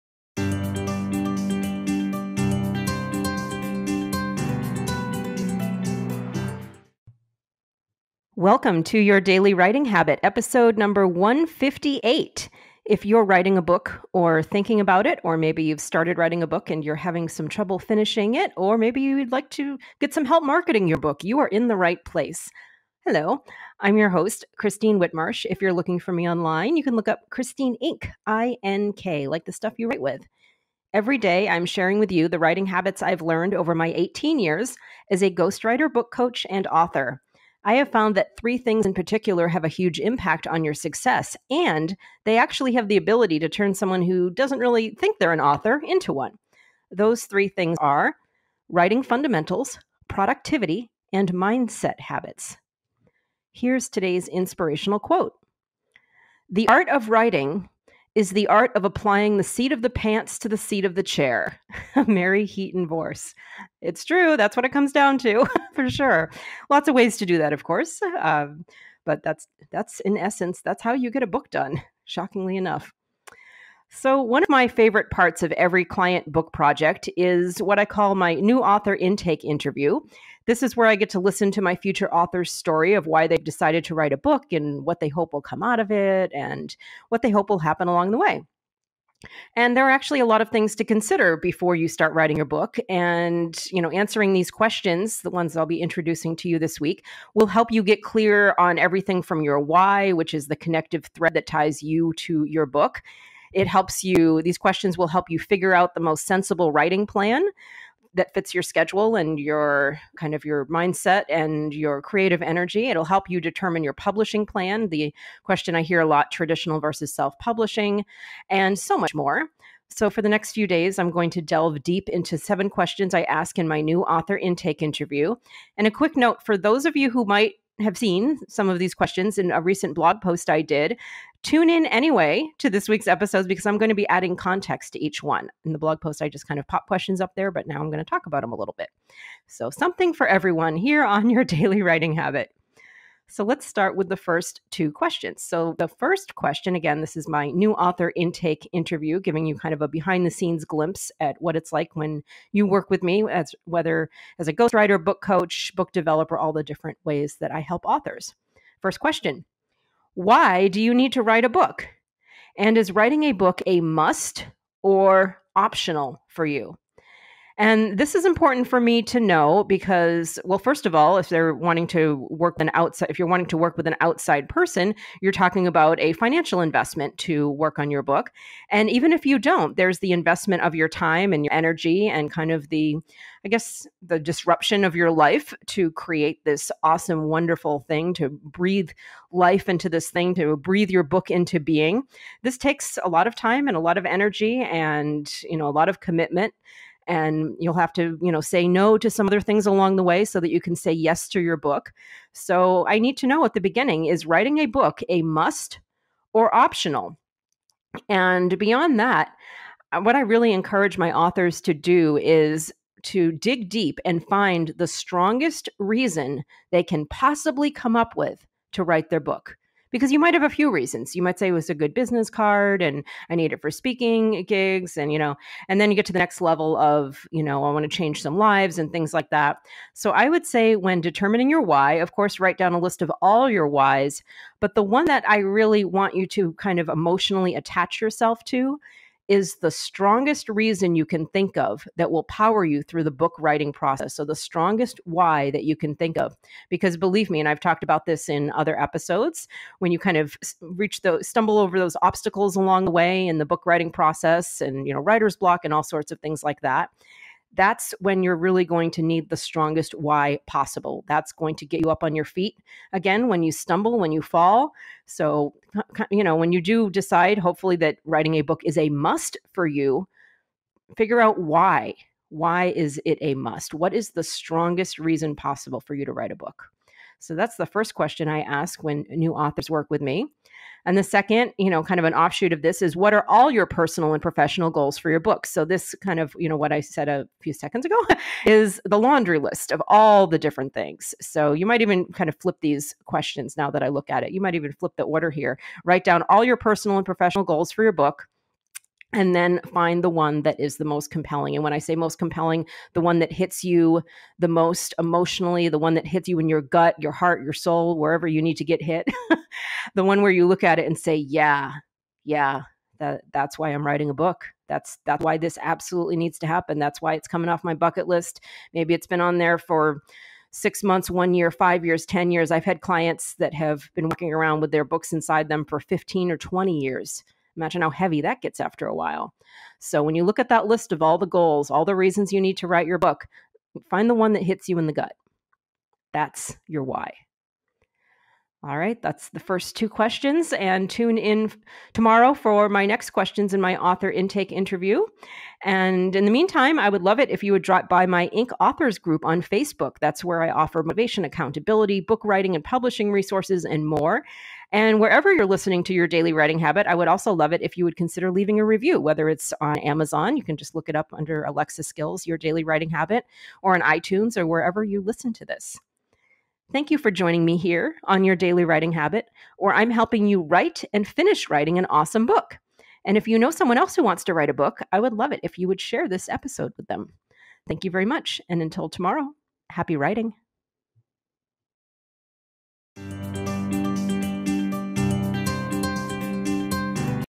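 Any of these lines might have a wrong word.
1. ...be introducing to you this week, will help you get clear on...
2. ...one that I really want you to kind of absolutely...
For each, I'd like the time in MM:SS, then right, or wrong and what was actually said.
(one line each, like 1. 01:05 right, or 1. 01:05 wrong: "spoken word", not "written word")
1. 01:35 right
2. 03:54 wrong: "emotionally", not "absolutely".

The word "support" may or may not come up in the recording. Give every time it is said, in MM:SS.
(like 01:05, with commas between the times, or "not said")
not said.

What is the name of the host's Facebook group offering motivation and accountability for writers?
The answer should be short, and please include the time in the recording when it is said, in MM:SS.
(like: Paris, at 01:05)
Ink Authors, at 05:48.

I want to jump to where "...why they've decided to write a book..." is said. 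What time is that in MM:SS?
01:23.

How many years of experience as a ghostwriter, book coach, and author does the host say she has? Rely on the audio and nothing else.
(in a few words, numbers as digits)
18.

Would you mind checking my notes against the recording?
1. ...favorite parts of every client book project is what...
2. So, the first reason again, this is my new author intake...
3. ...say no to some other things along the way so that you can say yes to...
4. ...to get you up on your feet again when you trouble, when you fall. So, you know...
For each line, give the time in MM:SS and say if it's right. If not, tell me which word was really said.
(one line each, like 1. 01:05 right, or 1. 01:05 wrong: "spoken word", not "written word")
1. 01:14 right
2. 02:25 wrong: "question", not "reason"
3. 03:18 right
4. 04:21 wrong: "stumble", not "trouble".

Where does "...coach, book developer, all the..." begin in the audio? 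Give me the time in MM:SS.
02:35.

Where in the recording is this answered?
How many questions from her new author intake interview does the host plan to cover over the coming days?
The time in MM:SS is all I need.
02:02.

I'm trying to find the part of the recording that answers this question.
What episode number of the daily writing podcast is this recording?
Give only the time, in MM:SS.
00:11.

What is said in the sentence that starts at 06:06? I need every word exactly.
Thank you for joining me here on your daily writing habit, or I'm helping you write and finish writing an awesome book.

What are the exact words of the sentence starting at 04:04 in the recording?
So, the strongest why that you can think of.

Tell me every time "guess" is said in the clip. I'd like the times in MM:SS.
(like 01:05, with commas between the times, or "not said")
03:03.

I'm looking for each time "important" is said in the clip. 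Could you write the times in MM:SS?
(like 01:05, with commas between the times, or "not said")
02:48.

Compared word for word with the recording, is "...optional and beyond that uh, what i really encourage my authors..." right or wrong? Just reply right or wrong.
right.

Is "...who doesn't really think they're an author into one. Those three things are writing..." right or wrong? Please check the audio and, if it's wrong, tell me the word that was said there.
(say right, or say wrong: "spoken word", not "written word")
right.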